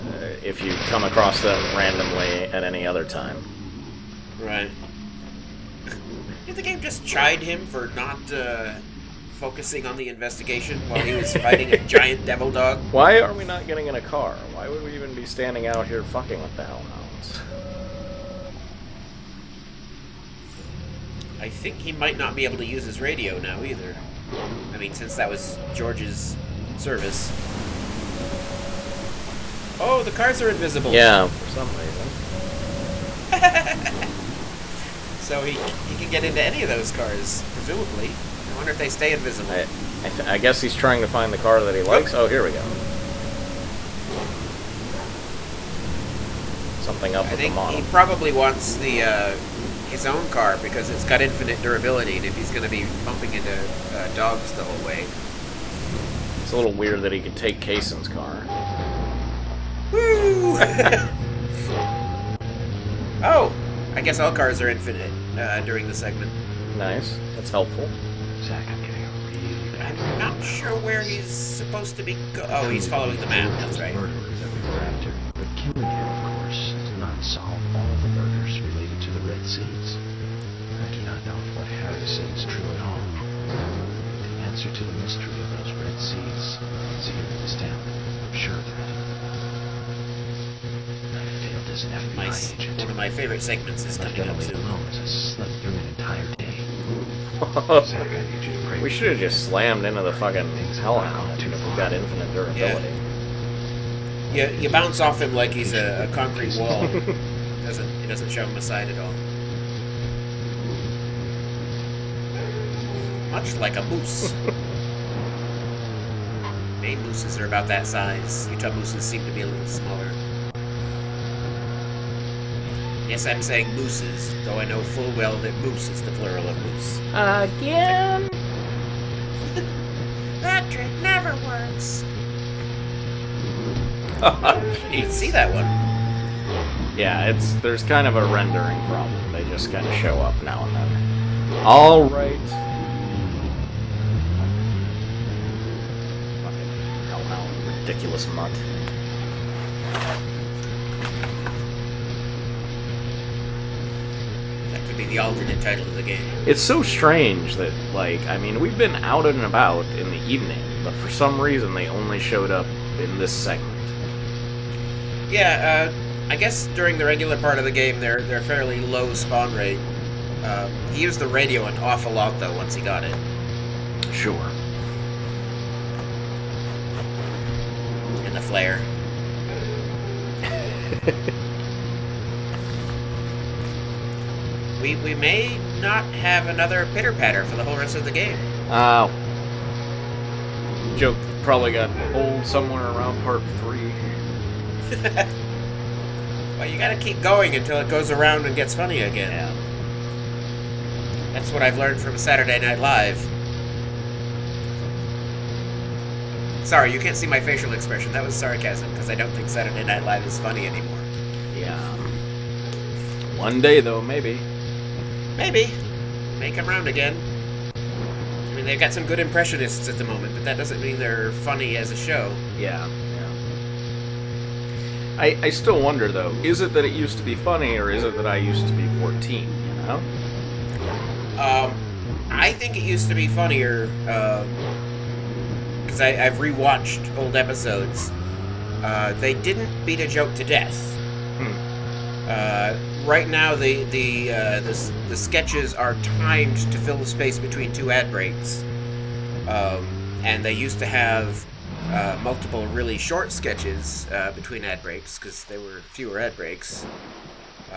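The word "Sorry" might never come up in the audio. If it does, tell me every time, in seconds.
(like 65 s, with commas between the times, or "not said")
206 s.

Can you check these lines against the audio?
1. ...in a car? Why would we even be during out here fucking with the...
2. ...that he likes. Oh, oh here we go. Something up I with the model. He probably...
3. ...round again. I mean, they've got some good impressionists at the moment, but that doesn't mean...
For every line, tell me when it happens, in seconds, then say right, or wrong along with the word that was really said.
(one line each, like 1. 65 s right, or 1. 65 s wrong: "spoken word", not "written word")
1. 13 s wrong: "standing", not "during"
2. 41 s right
3. 216 s right.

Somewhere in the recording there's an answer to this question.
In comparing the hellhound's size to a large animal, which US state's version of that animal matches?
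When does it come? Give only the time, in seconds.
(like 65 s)
116 s.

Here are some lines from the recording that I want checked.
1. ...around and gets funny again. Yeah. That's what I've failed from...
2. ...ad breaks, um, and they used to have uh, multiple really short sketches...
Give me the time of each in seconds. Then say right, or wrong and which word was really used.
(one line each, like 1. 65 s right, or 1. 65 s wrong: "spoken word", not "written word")
1. 198 s wrong: "learned", not "failed"
2. 247 s right.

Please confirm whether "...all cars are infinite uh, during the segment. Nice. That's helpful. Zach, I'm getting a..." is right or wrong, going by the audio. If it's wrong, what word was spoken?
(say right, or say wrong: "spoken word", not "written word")
right.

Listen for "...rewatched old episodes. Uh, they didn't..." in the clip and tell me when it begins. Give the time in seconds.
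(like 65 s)
236 s.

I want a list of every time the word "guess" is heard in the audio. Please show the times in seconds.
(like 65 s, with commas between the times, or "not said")
40 s, 64 s, 166 s.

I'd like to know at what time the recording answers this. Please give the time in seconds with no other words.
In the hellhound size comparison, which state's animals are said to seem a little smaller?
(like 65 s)
118 s.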